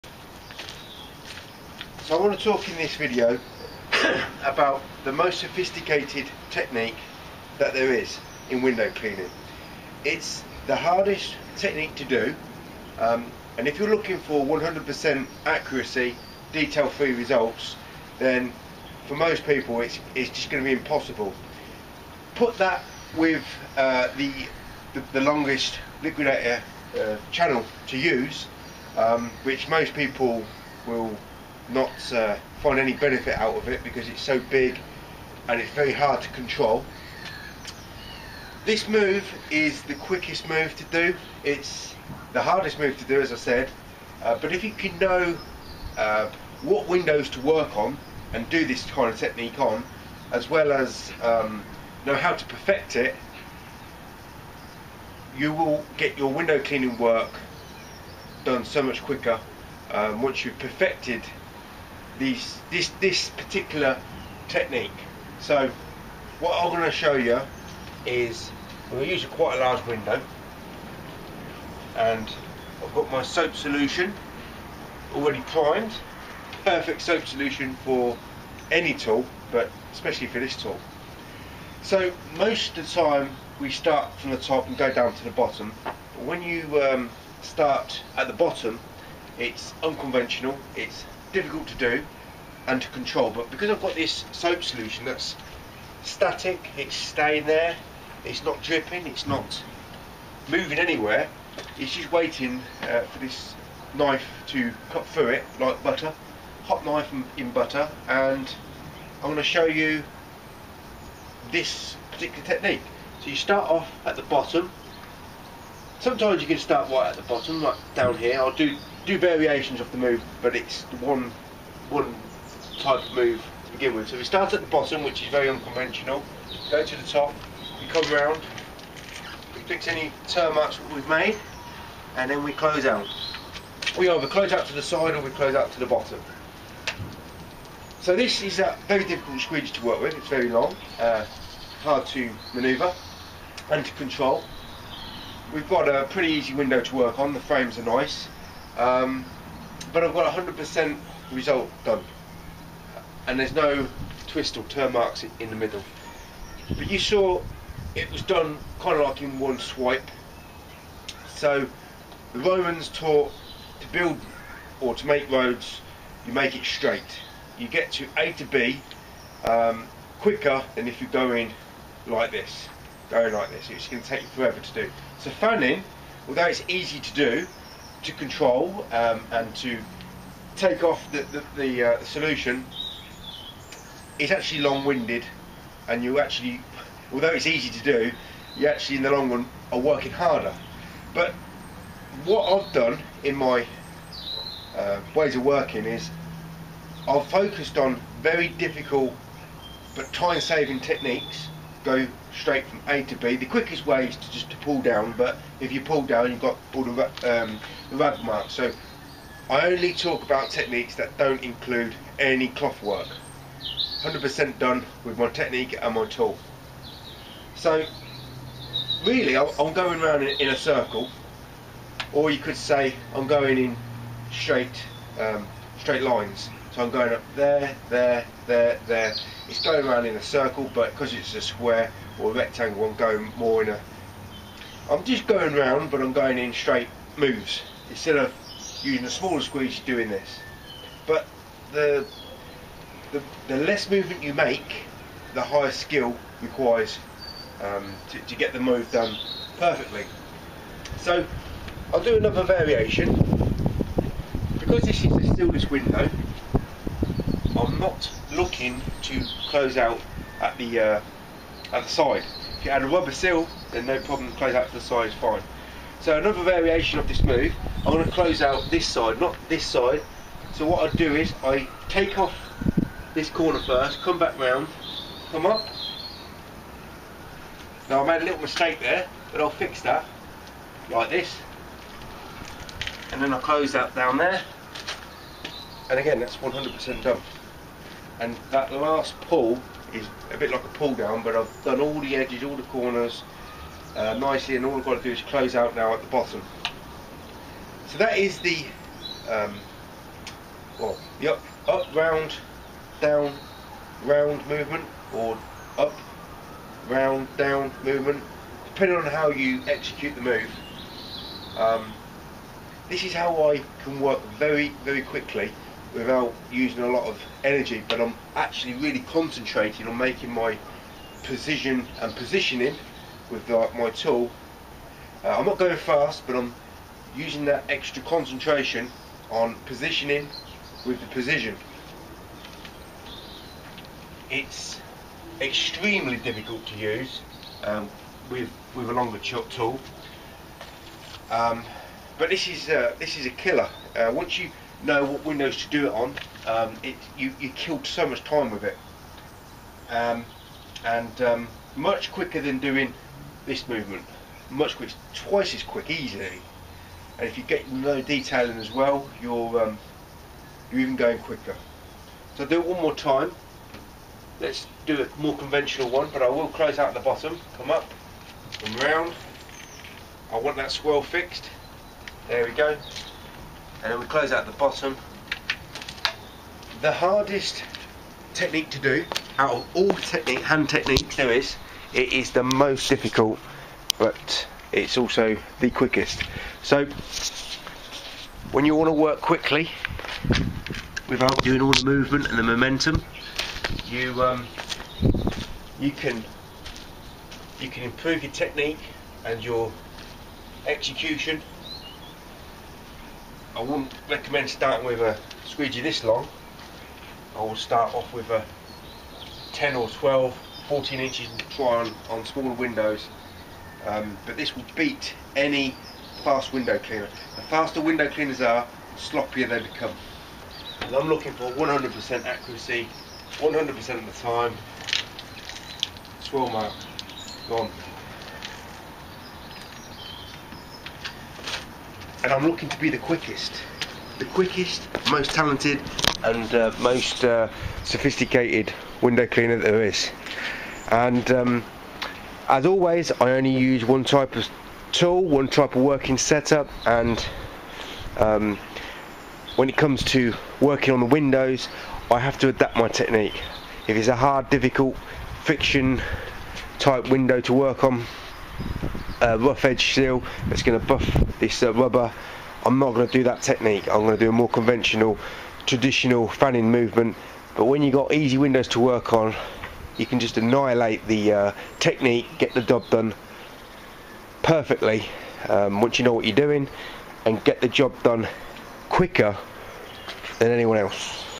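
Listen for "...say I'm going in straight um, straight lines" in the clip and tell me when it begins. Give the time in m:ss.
3:42.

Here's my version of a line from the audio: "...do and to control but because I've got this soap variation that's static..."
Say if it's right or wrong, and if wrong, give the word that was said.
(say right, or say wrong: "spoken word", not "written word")
wrong: "solution", not "variation".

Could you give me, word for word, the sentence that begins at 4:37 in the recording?
Now I made a little mistake there, but I'll fix that, like this.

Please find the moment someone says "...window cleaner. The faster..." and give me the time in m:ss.
6:56.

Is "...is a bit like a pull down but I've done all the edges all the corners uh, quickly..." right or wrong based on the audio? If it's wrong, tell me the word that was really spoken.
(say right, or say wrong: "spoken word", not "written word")
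wrong: "nicely", not "quickly".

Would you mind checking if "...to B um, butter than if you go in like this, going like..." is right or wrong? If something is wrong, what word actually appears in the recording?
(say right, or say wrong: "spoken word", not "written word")
wrong: "quicker", not "butter".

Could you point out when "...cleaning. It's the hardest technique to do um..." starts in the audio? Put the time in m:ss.
0:08.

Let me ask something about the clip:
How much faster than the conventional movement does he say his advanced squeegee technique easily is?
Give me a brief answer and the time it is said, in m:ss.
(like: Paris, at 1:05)
Twice as quick, at 5:55.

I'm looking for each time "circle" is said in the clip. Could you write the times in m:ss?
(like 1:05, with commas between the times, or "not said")
3:40, 3:50.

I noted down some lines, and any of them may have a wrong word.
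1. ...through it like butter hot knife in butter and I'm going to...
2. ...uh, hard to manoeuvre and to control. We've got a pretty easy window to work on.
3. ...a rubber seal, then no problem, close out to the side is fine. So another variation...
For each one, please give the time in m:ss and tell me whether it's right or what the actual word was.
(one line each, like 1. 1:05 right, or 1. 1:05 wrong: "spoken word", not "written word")
1. 1:45 right
2. 2:20 right
3. 4:22 right.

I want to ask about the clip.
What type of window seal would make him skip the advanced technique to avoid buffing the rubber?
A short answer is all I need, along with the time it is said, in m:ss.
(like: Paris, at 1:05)
Rough edge seal, at 7:39.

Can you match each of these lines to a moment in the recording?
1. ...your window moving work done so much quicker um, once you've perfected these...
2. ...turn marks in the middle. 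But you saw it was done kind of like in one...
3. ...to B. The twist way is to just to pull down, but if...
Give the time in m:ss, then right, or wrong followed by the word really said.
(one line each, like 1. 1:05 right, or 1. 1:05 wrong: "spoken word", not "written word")
1. 0:56 wrong: "cleaning", not "moving"
2. 2:34 right
3. 3:23 wrong: "quickest", not "twist".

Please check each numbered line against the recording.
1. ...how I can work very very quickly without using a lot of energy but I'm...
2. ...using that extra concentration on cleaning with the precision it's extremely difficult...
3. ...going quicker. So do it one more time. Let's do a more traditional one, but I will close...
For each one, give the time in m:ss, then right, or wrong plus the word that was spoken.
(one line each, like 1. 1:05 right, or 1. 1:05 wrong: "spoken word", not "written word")
1. 5:13 right
2. 5:27 wrong: "positioning", not "cleaning"
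3. 6:00 wrong: "conventional", not "traditional".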